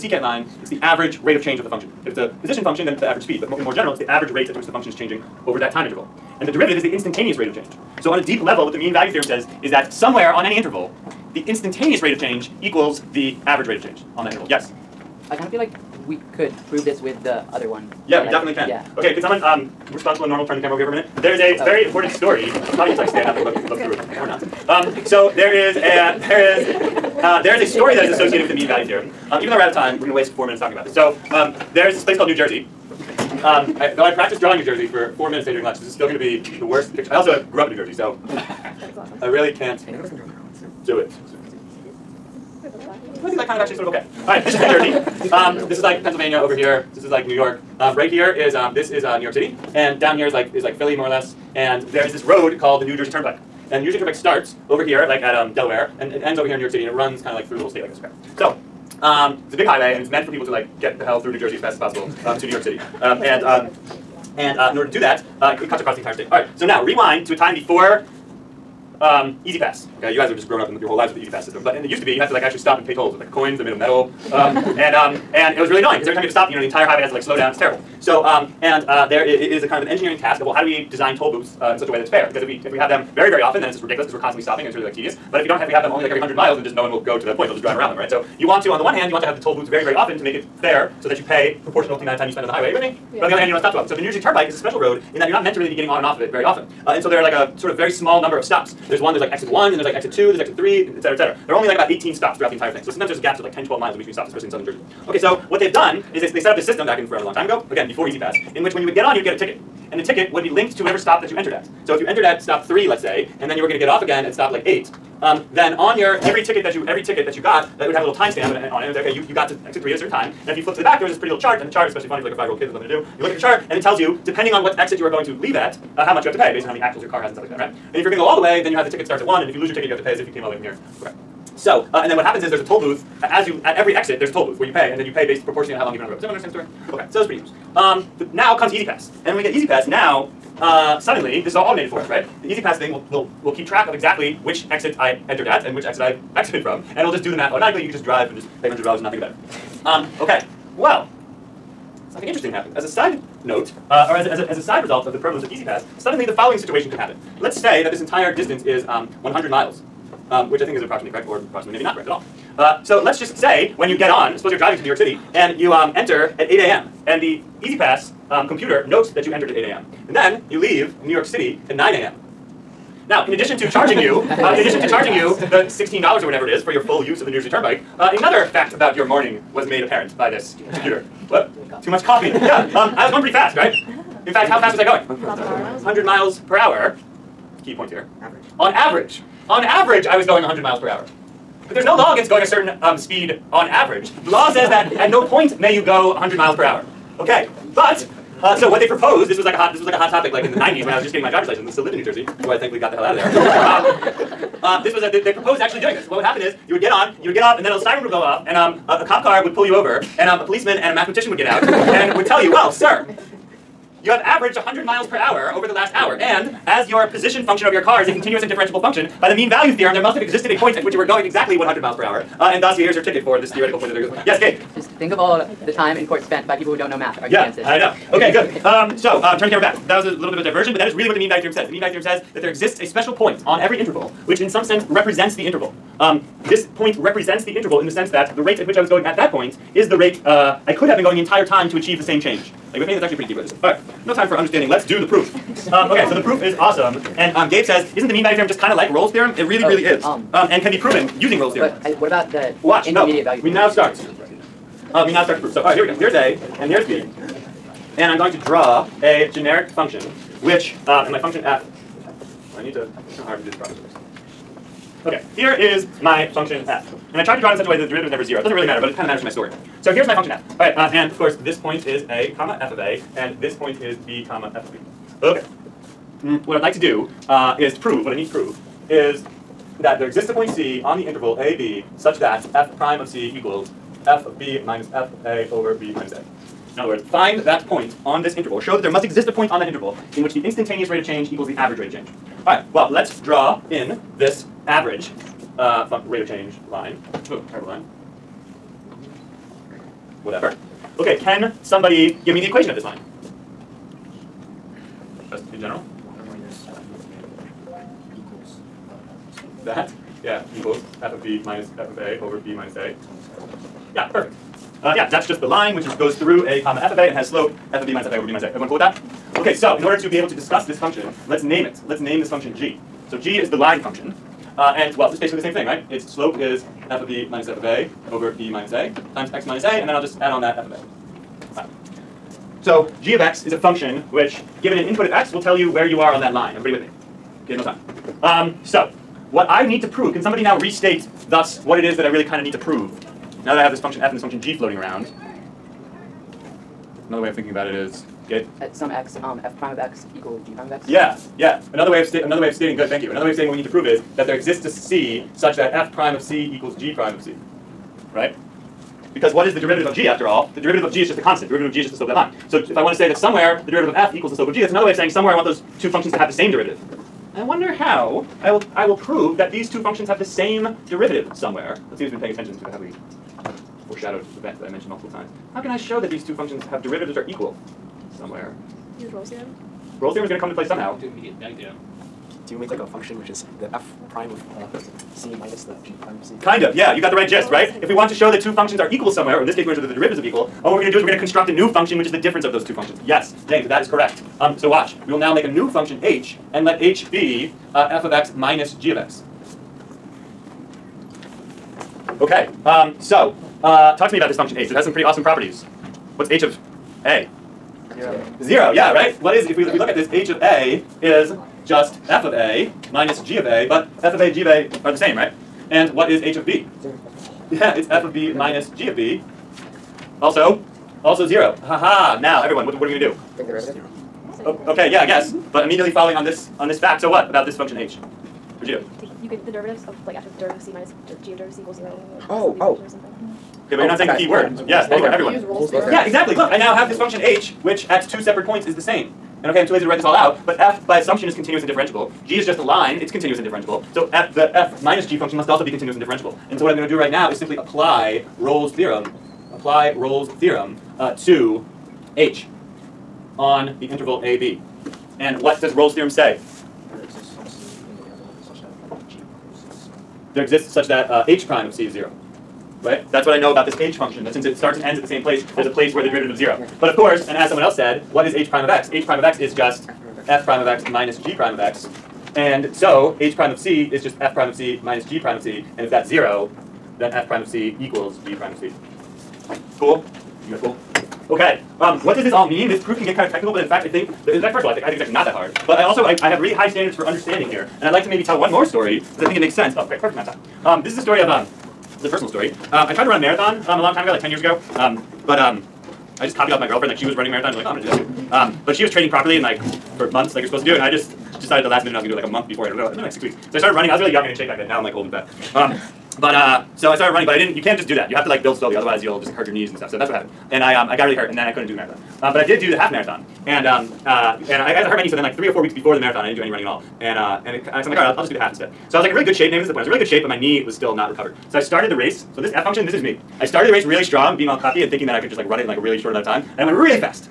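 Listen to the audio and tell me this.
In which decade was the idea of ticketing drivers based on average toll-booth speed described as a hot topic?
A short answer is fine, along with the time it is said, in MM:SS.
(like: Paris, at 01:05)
1990s, at 03:20.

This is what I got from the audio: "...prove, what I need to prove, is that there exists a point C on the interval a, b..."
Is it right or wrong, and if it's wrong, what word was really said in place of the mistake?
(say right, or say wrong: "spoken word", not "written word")
right.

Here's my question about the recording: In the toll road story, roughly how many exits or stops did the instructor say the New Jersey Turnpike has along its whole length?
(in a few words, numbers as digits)
18.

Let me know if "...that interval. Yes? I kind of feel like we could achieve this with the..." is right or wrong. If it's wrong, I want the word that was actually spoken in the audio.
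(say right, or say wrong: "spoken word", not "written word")
wrong: "prove", not "achieve".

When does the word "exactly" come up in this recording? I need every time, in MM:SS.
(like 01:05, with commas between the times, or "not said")
02:23, 03:41, 07:16.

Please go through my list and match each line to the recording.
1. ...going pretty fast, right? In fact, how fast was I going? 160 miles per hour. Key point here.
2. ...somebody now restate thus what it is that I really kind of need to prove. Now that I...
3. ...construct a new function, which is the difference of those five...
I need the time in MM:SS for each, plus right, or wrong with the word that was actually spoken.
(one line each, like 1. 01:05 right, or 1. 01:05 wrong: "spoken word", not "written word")
1. 03:03 wrong: "100", not "160"
2. 05:40 right
3. 06:31 wrong: "two", not "five".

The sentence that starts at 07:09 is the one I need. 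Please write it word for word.
You can the derivatives of like after the derivative of c minus g of derivative of c equals zero.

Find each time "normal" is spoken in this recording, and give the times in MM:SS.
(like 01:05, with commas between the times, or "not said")
00:20.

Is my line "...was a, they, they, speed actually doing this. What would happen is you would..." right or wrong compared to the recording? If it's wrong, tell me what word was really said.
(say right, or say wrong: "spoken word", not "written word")
wrong: "proposed", not "speed".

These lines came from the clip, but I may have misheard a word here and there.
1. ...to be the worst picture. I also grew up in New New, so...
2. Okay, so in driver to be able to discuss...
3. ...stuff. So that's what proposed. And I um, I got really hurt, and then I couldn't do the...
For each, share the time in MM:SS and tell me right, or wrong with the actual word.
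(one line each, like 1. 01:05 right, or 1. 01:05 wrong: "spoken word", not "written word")
1. 00:36 wrong: "Jersey", not "New"
2. 05:19 wrong: "order", not "driver"
3. 08:29 wrong: "happened", not "proposed".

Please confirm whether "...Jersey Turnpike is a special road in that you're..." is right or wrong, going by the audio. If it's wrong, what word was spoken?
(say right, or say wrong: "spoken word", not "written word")
right.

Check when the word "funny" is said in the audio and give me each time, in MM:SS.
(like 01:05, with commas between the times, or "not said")
02:02.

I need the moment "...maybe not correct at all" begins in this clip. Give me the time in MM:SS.
02:41.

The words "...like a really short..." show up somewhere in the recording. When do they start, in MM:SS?
08:45.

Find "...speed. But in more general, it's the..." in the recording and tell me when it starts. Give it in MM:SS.
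00:03.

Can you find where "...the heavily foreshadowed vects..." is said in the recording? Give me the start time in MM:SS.
06:12.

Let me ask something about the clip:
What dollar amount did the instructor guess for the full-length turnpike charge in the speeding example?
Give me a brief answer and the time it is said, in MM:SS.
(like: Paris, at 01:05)
$16, at 02:55.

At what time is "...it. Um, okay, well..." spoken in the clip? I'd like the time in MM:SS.
02:29.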